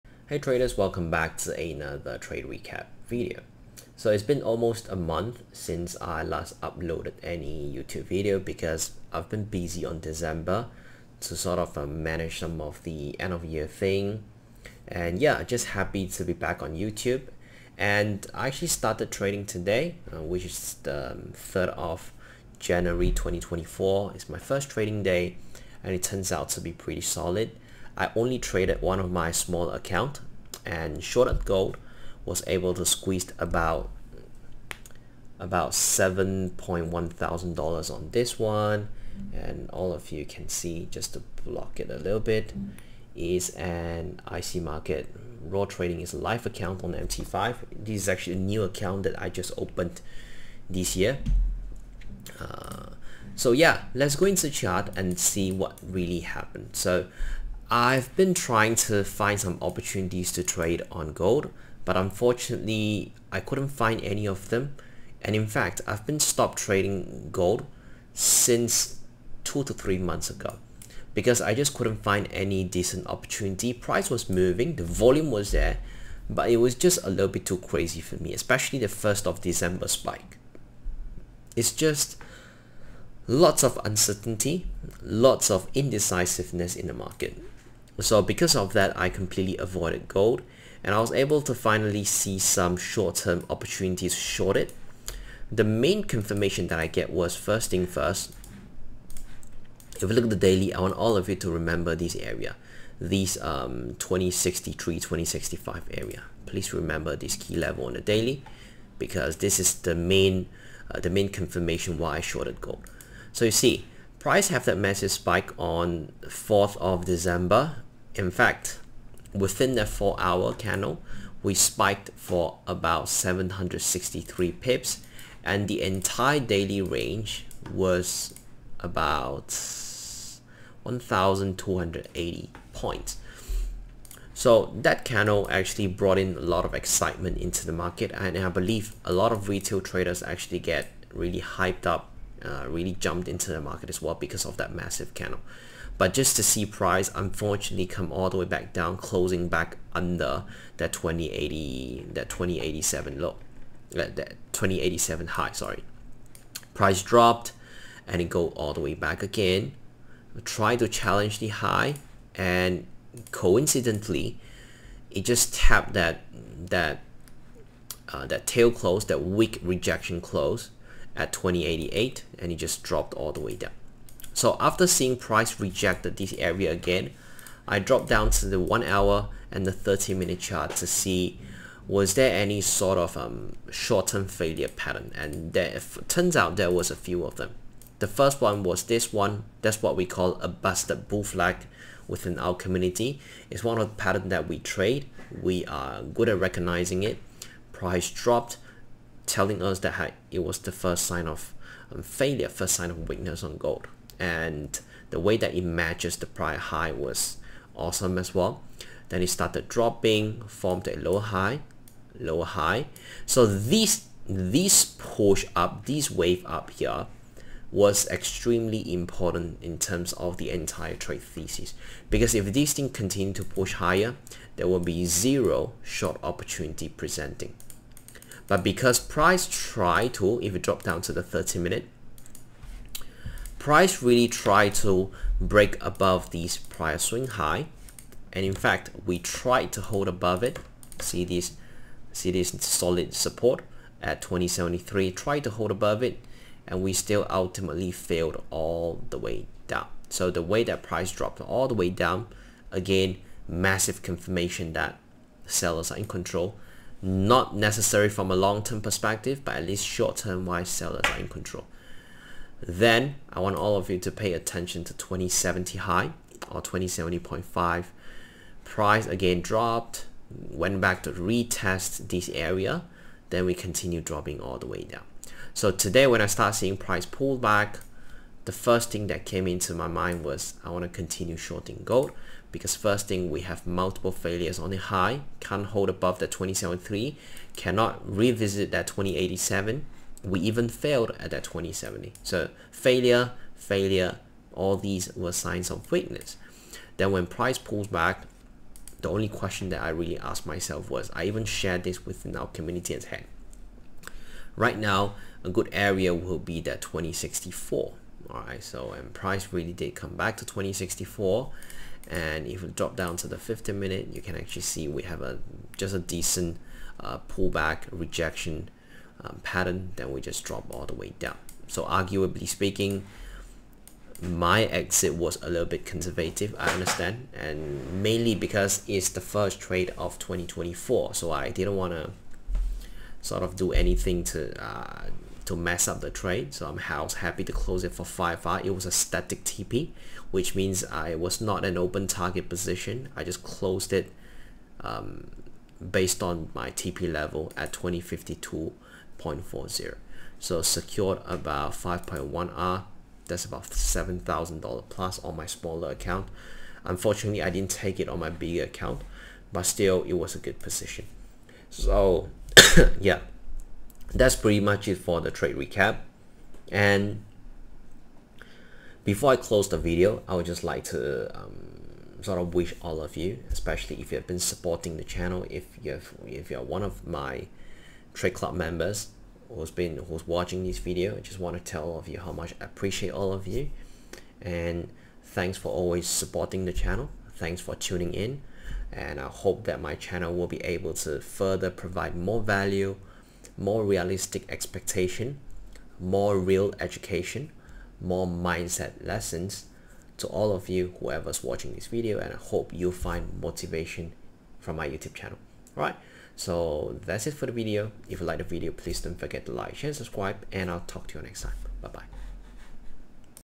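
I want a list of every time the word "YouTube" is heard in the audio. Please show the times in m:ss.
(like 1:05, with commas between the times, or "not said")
0:07, 0:16, 6:44.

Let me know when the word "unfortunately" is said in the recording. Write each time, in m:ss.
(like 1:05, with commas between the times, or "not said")
1:01, 2:27, 5:56.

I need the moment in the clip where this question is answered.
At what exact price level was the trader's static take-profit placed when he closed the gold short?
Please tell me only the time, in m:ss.
5:47.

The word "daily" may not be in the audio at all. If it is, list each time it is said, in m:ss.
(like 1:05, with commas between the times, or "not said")
1:40, 1:48, 2:06.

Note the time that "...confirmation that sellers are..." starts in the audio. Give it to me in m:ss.
4:14.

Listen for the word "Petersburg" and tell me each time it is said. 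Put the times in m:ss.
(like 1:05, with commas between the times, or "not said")
not said.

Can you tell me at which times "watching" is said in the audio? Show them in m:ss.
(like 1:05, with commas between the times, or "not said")
6:20, 6:41.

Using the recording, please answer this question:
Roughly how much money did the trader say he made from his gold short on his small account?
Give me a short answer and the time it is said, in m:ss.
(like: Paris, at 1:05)
$7,100, at 0:35.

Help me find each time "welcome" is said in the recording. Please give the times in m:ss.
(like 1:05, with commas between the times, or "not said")
0:00.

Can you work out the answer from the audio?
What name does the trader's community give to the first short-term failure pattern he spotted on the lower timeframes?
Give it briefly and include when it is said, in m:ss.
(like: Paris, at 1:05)
busted bull flag, at 3:10.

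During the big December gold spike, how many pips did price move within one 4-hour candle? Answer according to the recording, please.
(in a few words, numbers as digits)
763 pips.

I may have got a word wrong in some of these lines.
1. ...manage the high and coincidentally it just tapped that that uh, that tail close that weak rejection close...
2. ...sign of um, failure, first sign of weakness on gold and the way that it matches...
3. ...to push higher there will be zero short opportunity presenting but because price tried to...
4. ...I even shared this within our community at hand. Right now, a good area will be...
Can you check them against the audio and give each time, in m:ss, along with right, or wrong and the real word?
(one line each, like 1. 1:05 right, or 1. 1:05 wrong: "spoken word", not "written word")
1. 2:40 wrong: "challenge", not "manage"
2. 3:21 right
3. 3:43 right
4. 5:01 right.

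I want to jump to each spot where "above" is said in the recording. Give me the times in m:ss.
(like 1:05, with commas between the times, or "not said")
3:55, 4:00, 4:05, 4:45.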